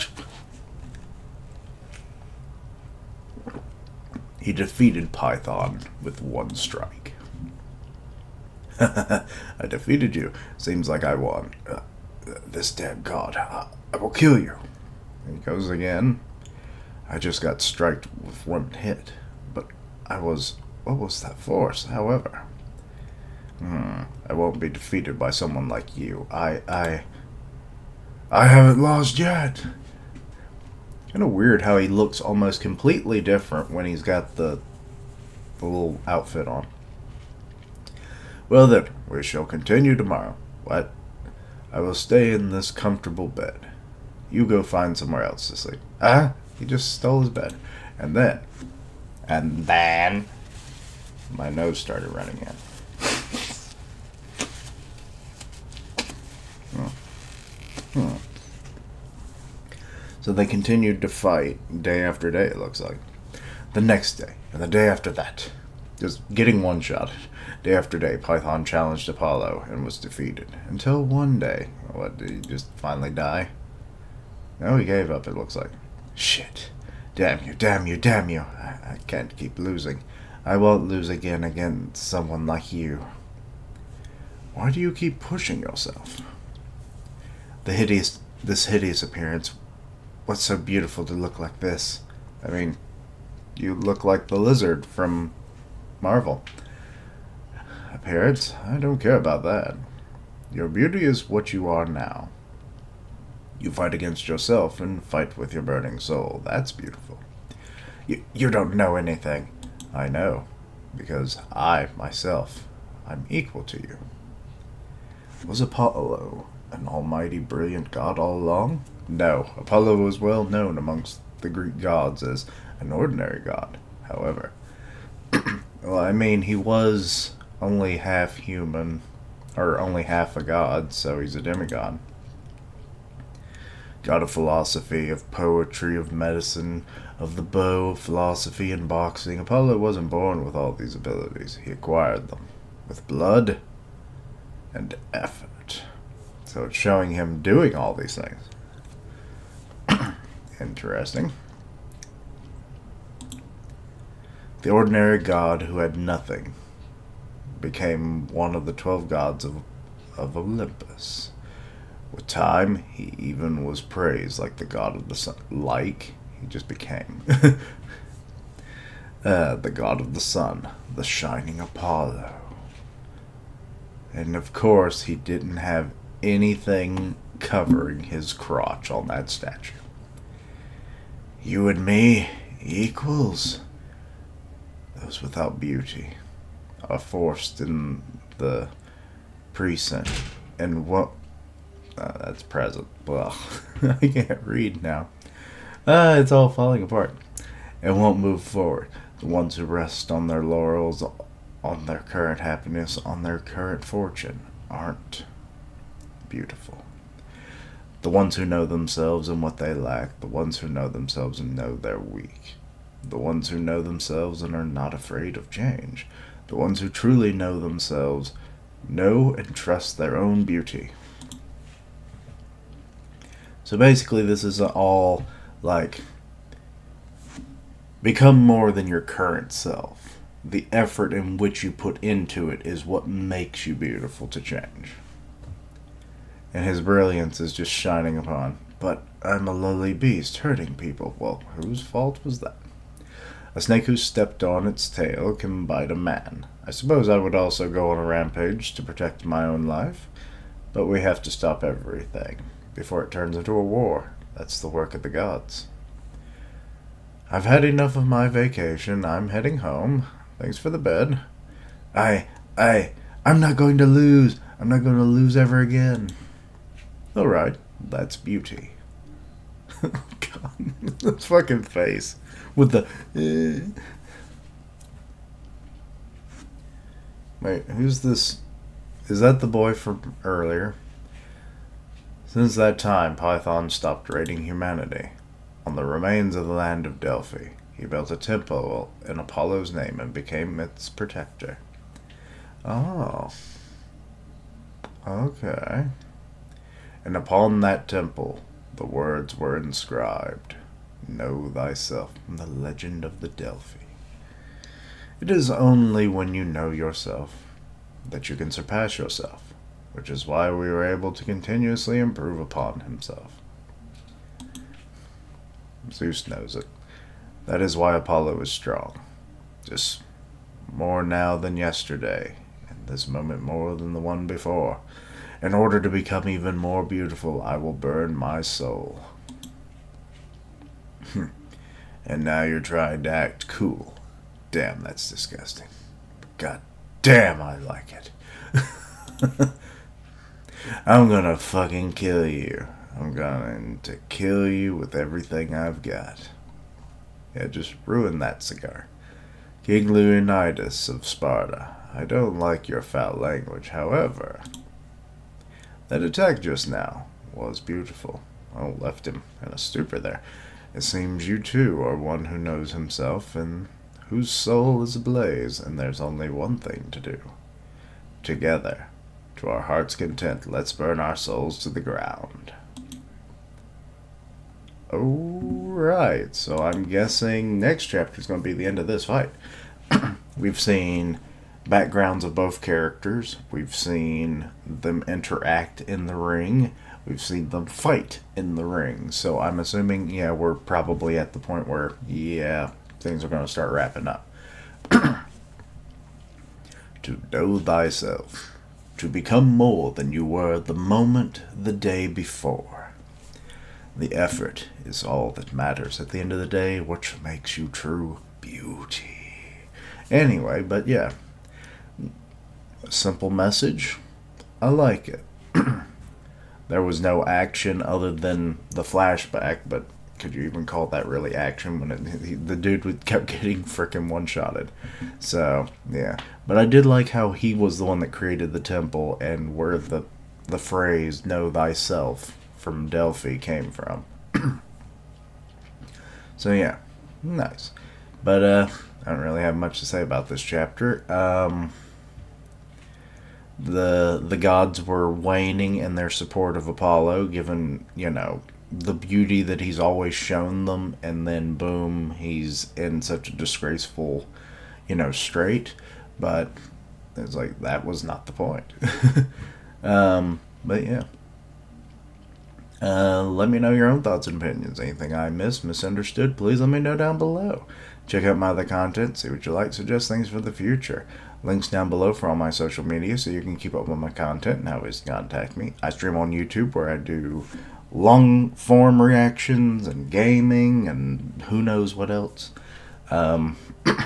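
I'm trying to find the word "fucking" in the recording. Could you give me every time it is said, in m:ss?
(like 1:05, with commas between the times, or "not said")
4:31, 5:41.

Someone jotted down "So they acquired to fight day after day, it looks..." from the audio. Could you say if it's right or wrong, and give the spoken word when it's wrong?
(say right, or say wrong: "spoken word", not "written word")
wrong: "continued", not "acquired".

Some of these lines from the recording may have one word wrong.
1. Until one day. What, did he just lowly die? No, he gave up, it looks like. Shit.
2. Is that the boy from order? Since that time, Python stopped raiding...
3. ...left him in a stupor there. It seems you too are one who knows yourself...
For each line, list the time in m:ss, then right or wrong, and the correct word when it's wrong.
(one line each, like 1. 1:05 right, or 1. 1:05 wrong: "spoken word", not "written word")
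1. 1:10 wrong: "finally", not "lowly"
2. 4:39 wrong: "earlier", not "order"
3. 5:58 wrong: "himself", not "yourself".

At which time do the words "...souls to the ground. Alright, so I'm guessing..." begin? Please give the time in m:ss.
6:11.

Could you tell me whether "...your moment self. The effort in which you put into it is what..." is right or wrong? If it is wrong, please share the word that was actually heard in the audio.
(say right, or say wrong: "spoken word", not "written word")
wrong: "current", not "moment".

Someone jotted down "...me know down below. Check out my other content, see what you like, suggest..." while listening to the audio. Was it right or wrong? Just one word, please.
right.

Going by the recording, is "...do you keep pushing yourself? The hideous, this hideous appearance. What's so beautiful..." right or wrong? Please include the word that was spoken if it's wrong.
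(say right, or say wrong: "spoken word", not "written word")
right.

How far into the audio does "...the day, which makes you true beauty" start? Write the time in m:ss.
6:46.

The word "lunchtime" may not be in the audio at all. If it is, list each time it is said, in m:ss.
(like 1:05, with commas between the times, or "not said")
not said.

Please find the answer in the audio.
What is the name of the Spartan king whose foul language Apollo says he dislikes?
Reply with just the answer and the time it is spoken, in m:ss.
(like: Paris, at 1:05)
Leonidas, at 5:49.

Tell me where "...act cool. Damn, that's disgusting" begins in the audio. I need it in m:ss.
5:33.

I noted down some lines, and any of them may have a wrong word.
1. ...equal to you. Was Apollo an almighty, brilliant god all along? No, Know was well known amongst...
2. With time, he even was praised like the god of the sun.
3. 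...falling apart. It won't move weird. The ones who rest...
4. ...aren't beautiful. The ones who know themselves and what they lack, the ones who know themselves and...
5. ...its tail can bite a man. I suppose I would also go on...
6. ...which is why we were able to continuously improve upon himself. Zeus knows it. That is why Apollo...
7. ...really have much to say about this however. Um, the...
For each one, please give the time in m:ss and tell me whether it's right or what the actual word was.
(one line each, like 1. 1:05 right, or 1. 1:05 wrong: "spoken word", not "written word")
1. 1:53 wrong: "Apollo", not "Know"
2. 2:42 right
3. 3:16 wrong: "forward", not "weird"
4. 3:24 right
5. 4:04 right
6. 5:09 right
7. 7:19 wrong: "chapter", not "however".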